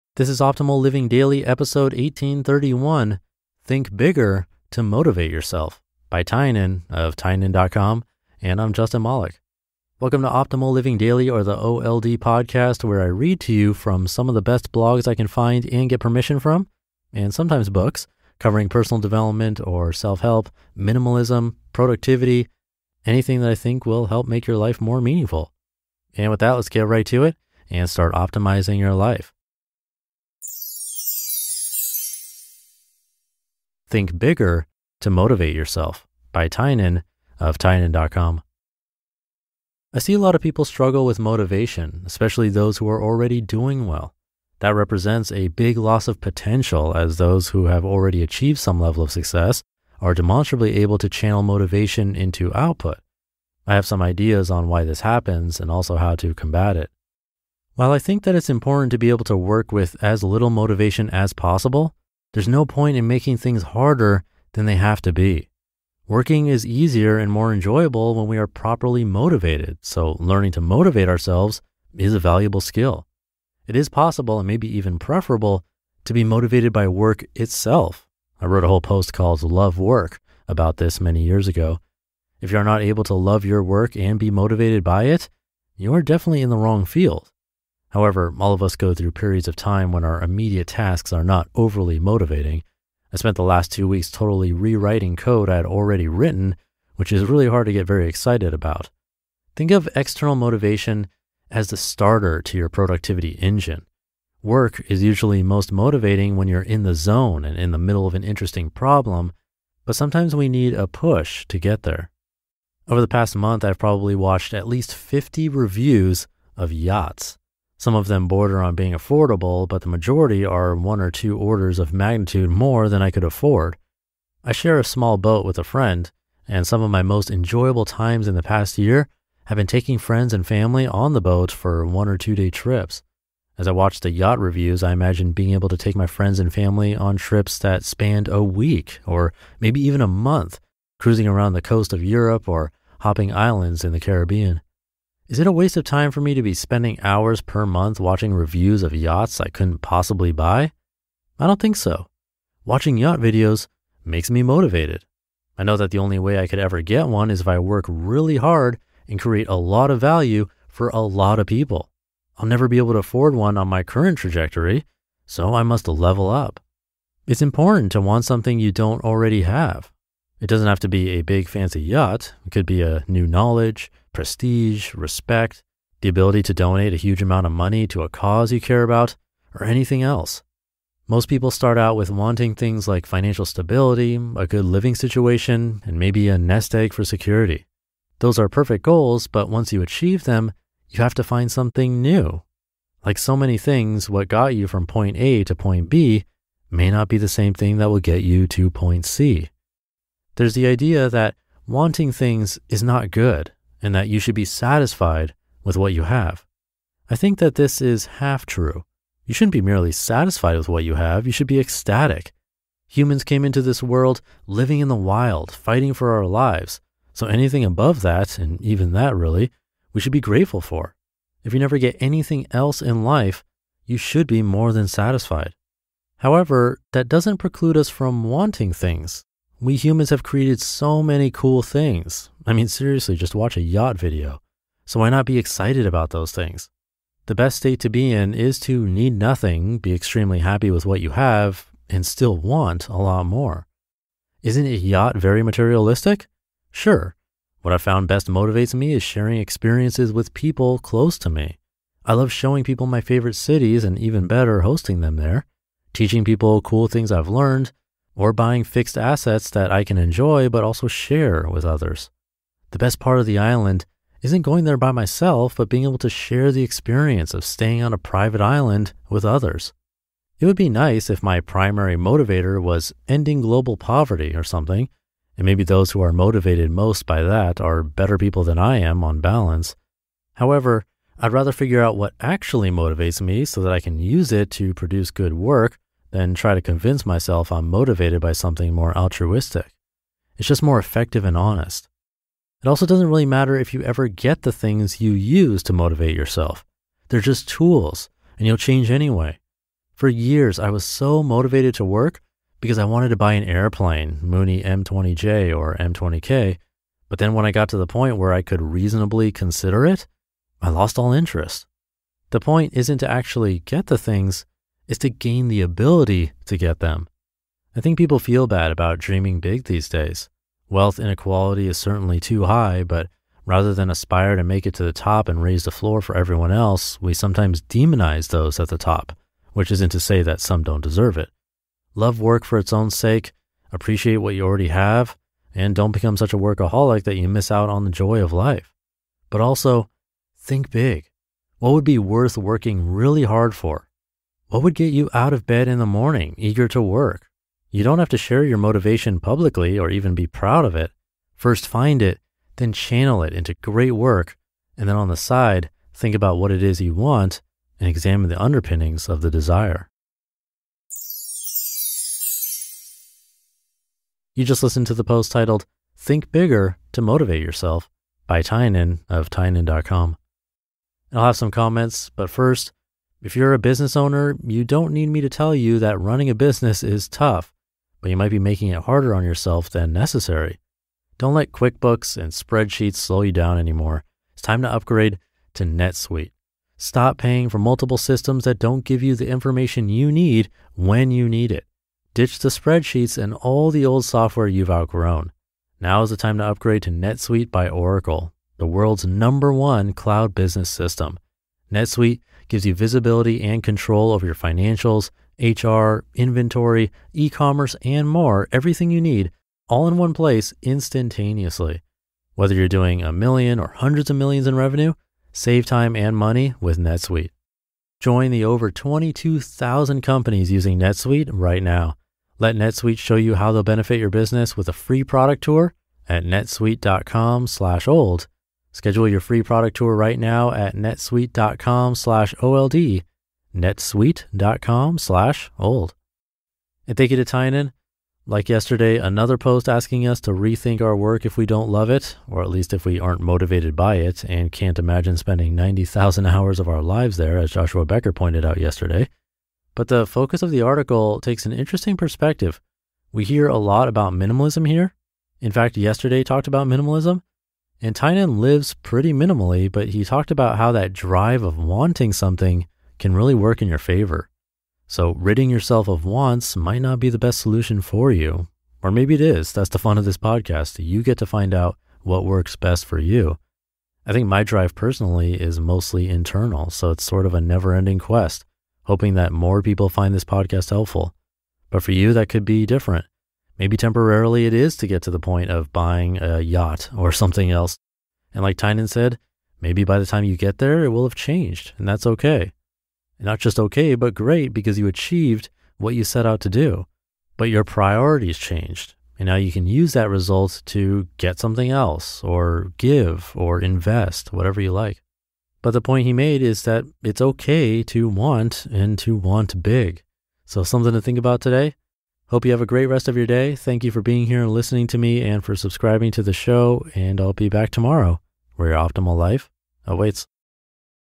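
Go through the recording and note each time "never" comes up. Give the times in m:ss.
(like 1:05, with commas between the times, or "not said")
2:42, 3:41, 7:57.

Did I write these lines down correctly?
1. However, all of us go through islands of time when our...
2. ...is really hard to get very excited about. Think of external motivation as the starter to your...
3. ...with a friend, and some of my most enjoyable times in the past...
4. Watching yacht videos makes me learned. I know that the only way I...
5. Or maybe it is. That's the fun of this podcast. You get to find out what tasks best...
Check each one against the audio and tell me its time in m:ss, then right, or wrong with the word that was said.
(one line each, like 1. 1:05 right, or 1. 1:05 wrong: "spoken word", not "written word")
1. 1:27 wrong: "periods", not "islands"
2. 1:37 right
3. 2:05 right
4. 2:32 wrong: "motivated", not "learned"
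5. 7:48 wrong: "works", not "tasks".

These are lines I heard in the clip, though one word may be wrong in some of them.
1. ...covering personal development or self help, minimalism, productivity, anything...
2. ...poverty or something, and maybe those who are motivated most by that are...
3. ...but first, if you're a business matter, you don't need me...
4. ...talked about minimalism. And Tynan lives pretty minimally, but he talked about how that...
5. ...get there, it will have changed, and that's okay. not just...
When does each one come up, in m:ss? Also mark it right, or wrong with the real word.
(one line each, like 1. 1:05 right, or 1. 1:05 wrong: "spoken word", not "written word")
1. 0:18 right
2. 4:33 right
3. 6:12 wrong: "owner", not "matter"
4. 7:36 right
5. 8:10 right.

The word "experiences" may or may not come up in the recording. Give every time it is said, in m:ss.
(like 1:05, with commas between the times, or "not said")
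4:09, 4:26.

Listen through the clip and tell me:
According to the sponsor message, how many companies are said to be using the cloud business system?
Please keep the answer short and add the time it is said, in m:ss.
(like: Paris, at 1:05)
22,000, at 6:58.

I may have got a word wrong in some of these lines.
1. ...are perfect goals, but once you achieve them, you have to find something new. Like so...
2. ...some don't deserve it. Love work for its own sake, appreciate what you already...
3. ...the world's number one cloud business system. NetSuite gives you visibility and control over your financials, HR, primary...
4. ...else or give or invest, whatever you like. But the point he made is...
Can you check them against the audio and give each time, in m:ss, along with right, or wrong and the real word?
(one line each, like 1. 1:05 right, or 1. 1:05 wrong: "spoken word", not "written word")
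1. 3:08 right
2. 5:30 right
3. 6:38 wrong: "inventory", not "primary"
4. 8:21 right.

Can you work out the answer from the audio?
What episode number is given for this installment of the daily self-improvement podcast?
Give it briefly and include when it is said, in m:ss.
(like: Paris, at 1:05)
1831, at 0:01.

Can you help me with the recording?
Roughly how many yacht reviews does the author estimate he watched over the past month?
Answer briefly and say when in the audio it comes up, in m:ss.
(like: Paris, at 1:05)
50, at 1:54.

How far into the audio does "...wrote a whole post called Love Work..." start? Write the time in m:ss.
1:18.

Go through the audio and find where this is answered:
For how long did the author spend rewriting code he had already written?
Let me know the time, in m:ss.
1:33.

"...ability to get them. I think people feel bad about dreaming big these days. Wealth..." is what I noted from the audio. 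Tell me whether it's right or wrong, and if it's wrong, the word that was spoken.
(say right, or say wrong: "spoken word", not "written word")
right.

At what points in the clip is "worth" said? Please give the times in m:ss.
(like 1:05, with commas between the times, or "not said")
5:41.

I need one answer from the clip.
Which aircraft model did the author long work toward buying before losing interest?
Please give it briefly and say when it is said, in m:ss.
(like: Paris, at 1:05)
Mooney M20J, at 5:04.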